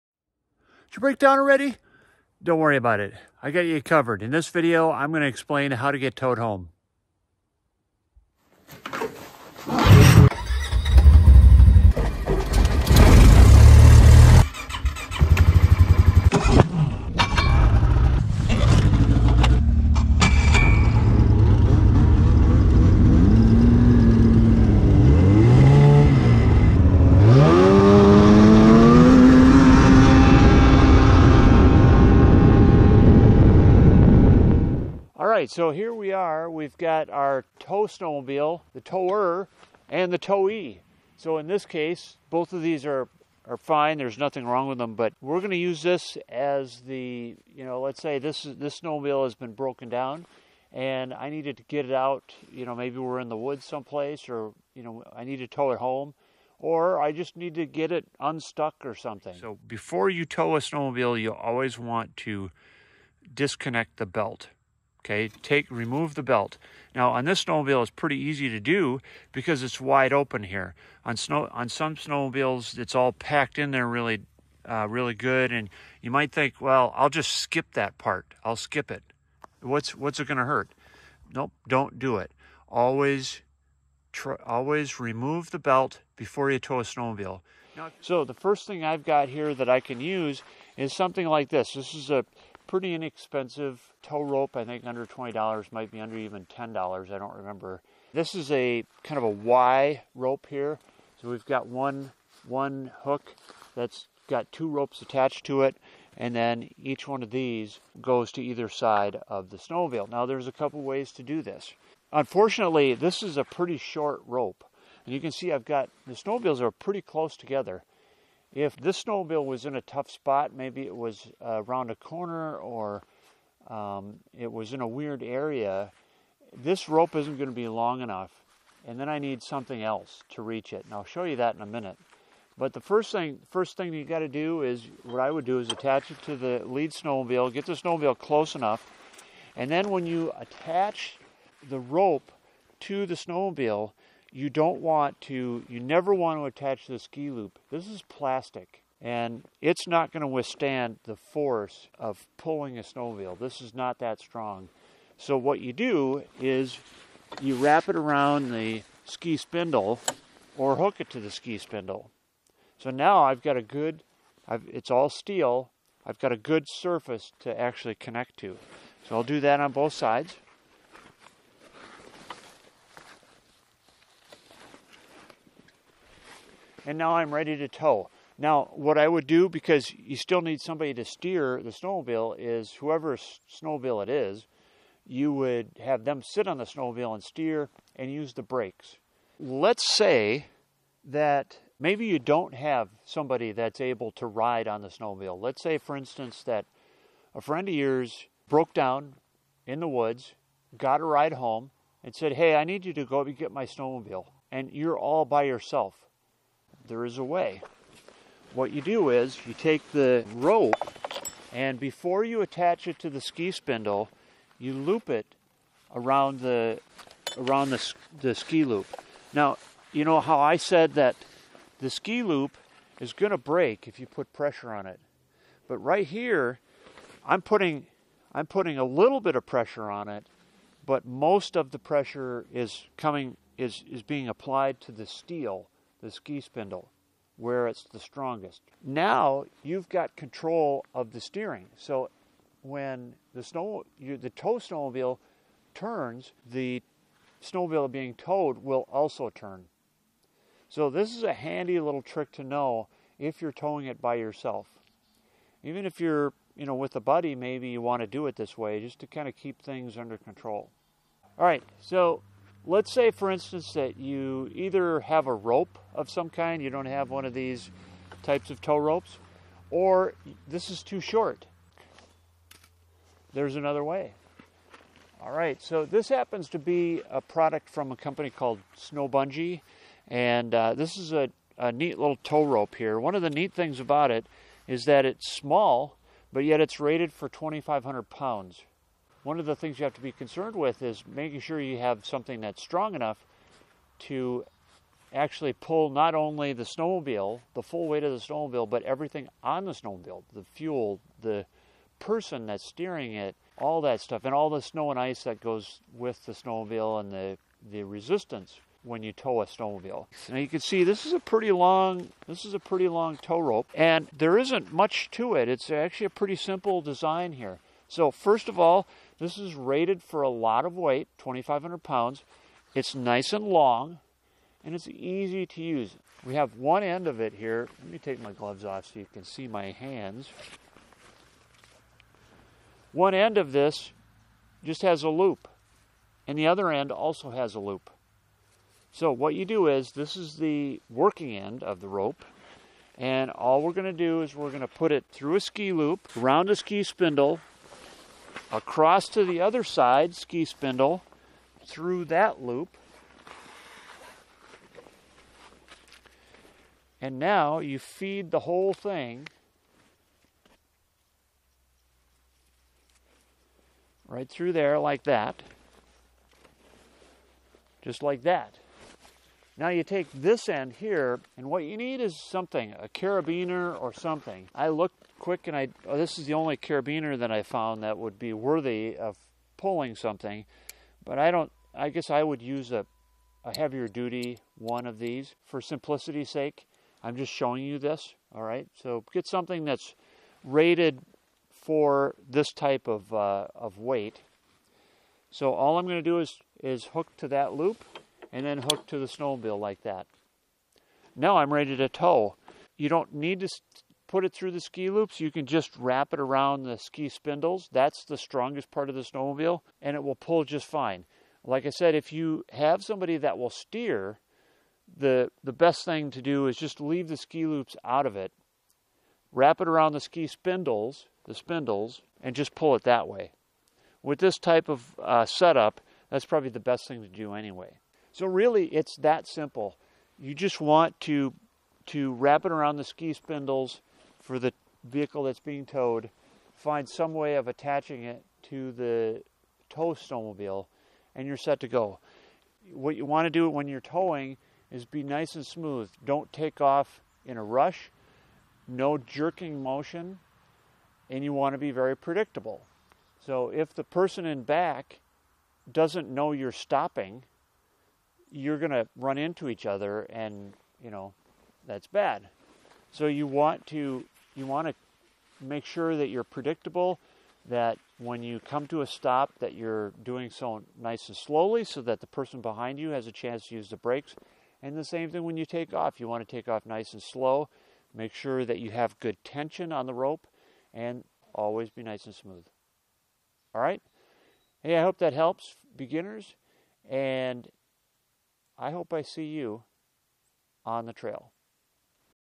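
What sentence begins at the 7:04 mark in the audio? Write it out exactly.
With this type of uh, setup, that's probably the best thing to do anyway.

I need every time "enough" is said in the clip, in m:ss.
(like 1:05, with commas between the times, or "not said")
2:08, 2:18, 4:52.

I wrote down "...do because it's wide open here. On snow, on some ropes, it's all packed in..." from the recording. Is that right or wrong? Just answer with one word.
wrong.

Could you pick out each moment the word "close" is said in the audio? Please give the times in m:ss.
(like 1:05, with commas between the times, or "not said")
1:57, 2:18.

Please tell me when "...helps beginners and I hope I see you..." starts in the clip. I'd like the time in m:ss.
8:05.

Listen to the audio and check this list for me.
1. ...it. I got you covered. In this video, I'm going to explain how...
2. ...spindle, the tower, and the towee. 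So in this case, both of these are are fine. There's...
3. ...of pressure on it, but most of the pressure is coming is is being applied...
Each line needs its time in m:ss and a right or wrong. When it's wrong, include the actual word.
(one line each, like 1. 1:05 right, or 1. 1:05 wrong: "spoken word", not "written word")
1. 0:02 right
2. 0:37 wrong: "snowmobile", not "spindle"
3. 3:49 right.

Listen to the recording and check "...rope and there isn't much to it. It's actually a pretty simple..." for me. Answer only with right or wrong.
right.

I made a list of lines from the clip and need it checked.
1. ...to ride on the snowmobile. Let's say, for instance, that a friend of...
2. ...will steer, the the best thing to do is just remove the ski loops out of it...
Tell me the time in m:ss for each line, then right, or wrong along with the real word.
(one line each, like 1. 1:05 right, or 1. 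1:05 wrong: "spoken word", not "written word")
1. 3:14 right
2. 6:53 wrong: "leave", not "remove".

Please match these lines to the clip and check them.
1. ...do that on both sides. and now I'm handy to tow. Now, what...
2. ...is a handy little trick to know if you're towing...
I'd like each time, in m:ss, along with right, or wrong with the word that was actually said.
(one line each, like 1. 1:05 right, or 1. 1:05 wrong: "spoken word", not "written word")
1. 2:49 wrong: "ready", not "handy"
2. 4:11 right.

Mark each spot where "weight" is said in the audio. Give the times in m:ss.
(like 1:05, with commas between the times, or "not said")
4:57, 5:20, 6:33.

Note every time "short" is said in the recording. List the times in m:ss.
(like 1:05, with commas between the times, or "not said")
1:53, 4:30.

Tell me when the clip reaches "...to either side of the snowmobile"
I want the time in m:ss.
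1:48.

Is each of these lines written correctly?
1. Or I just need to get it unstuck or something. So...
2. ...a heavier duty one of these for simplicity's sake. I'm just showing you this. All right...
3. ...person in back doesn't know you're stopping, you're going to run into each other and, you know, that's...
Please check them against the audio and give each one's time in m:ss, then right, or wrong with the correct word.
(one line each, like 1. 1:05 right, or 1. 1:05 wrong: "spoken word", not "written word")
1. 0:56 right
2. 6:23 right
3. 7:33 right.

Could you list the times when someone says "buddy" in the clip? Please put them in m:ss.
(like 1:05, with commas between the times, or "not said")
4:16.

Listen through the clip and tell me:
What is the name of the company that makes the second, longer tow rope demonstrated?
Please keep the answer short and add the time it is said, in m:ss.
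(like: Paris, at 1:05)
Snow Bungee, at 4:38.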